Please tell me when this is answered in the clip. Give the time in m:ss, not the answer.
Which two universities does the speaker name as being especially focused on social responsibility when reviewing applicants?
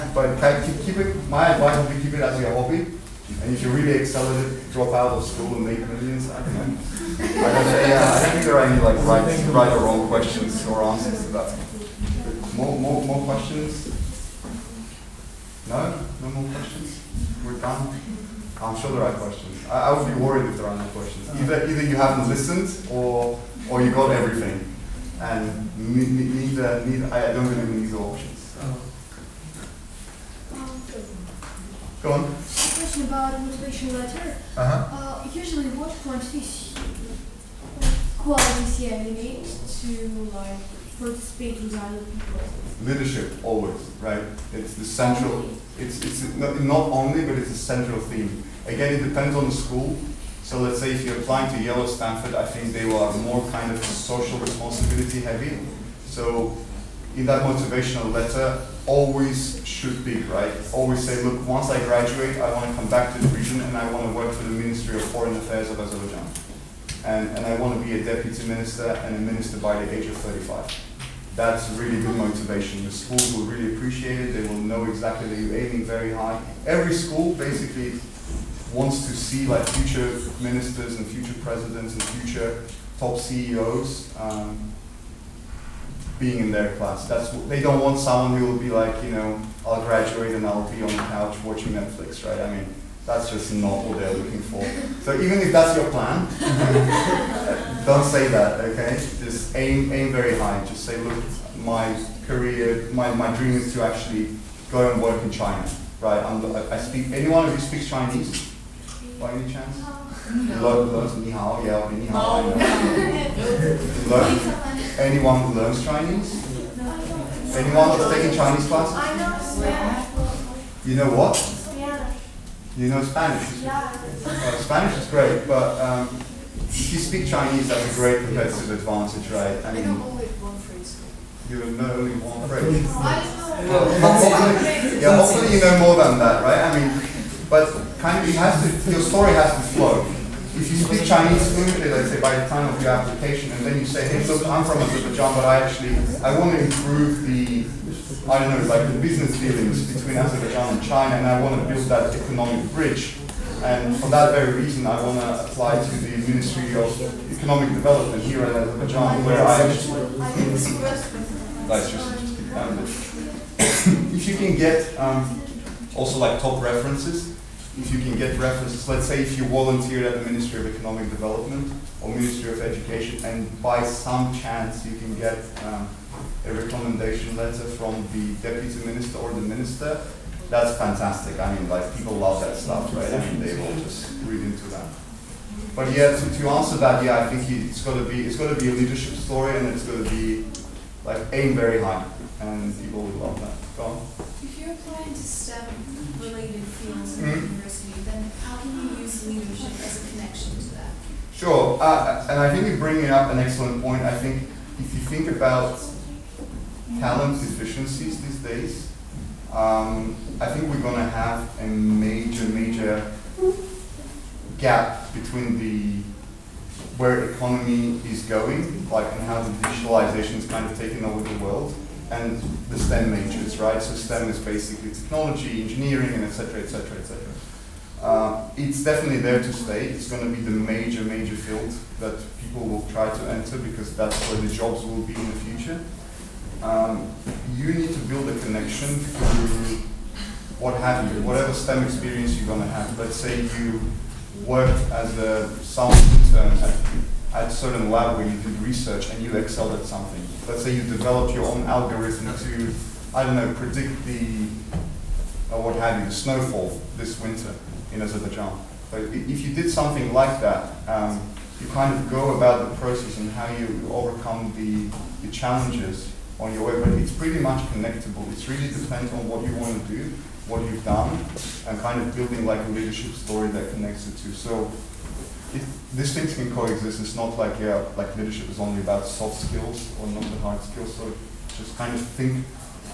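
0:51.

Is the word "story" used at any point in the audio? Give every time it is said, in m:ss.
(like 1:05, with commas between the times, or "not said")
2:19, 3:09, 4:33.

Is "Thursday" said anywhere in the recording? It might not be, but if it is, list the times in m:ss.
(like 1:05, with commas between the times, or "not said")
not said.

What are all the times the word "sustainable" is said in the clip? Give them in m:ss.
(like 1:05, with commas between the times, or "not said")
not said.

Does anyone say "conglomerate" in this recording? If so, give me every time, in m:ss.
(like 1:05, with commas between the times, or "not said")
not said.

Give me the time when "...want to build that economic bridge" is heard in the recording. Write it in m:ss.
2:31.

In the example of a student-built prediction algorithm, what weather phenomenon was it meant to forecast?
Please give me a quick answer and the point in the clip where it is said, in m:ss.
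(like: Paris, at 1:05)
snowfall, at 4:16.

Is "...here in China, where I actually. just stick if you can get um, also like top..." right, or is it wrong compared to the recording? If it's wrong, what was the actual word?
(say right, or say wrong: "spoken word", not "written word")
wrong: "Azerbaijan", not "China".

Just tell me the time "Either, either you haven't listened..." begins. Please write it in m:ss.
0:21.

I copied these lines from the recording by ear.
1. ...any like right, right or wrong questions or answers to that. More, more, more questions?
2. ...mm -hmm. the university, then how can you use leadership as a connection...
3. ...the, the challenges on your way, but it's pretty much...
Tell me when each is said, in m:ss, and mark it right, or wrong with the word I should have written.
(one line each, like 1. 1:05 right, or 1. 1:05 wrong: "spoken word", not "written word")
1. 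0:08 right
2. 3:17 right
3. 4:24 right.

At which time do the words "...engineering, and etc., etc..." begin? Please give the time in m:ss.
3:45.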